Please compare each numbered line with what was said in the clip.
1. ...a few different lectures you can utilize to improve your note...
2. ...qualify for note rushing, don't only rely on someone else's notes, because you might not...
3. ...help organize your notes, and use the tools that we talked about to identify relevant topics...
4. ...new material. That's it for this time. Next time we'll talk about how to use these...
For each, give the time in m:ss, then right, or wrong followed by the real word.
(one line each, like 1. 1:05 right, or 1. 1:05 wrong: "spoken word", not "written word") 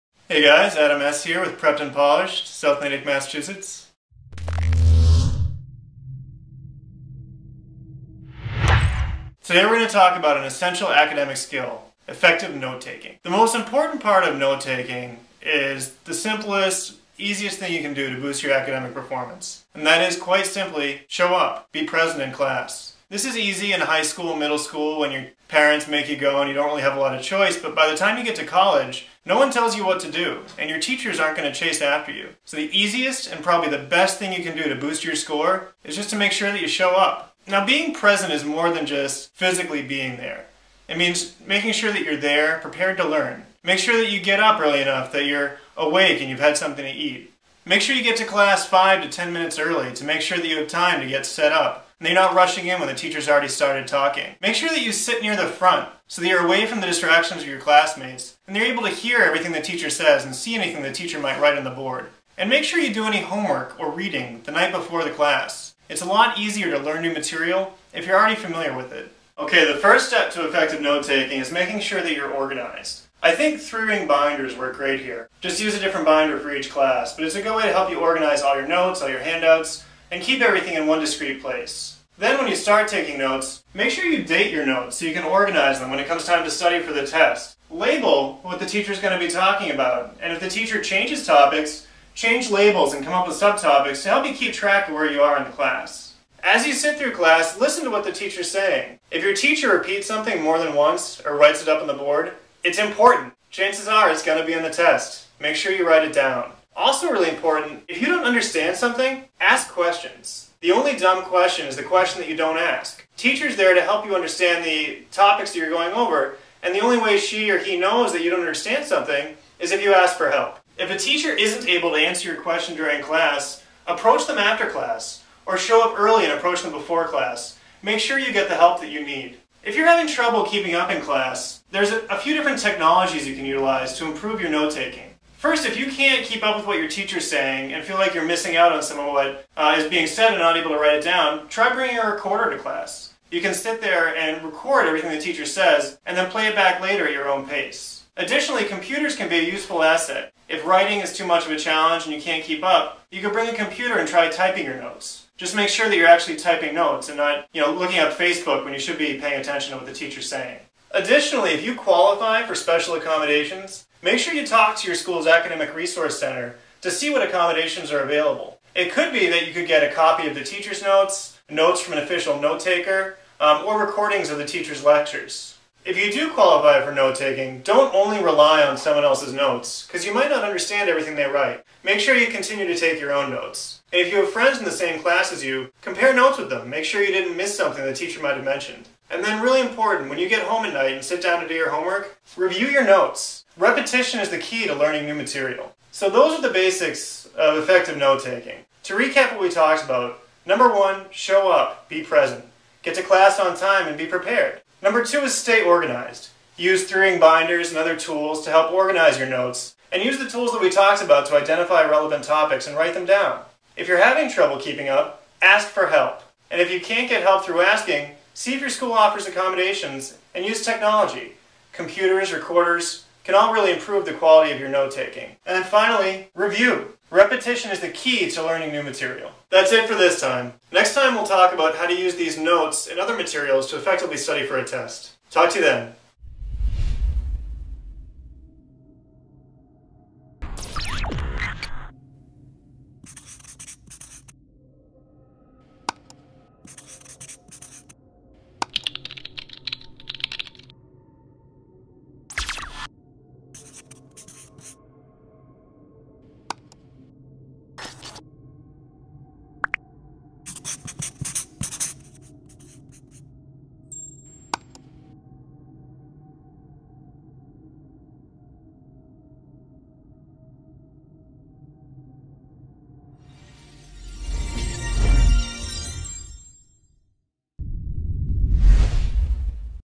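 1. 2:11 wrong: "technologies", not "lectures"
2. 2:56 wrong: "taking", not "rushing"
3. 3:28 right
4. 3:48 right.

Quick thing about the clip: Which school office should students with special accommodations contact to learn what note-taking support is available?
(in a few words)
Academic Resource Center.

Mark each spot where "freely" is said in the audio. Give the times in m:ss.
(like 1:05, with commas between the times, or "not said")
not said.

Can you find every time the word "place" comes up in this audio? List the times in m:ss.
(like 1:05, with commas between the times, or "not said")
1:21.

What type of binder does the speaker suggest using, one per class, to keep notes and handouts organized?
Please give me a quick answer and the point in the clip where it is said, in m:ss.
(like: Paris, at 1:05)
Three ring binders, at 1:13.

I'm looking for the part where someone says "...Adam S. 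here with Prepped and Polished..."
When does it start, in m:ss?
0:00.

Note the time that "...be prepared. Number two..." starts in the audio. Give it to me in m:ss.
3:23.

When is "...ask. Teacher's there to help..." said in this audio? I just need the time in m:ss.
1:52.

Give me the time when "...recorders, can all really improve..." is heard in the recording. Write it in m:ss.
3:42.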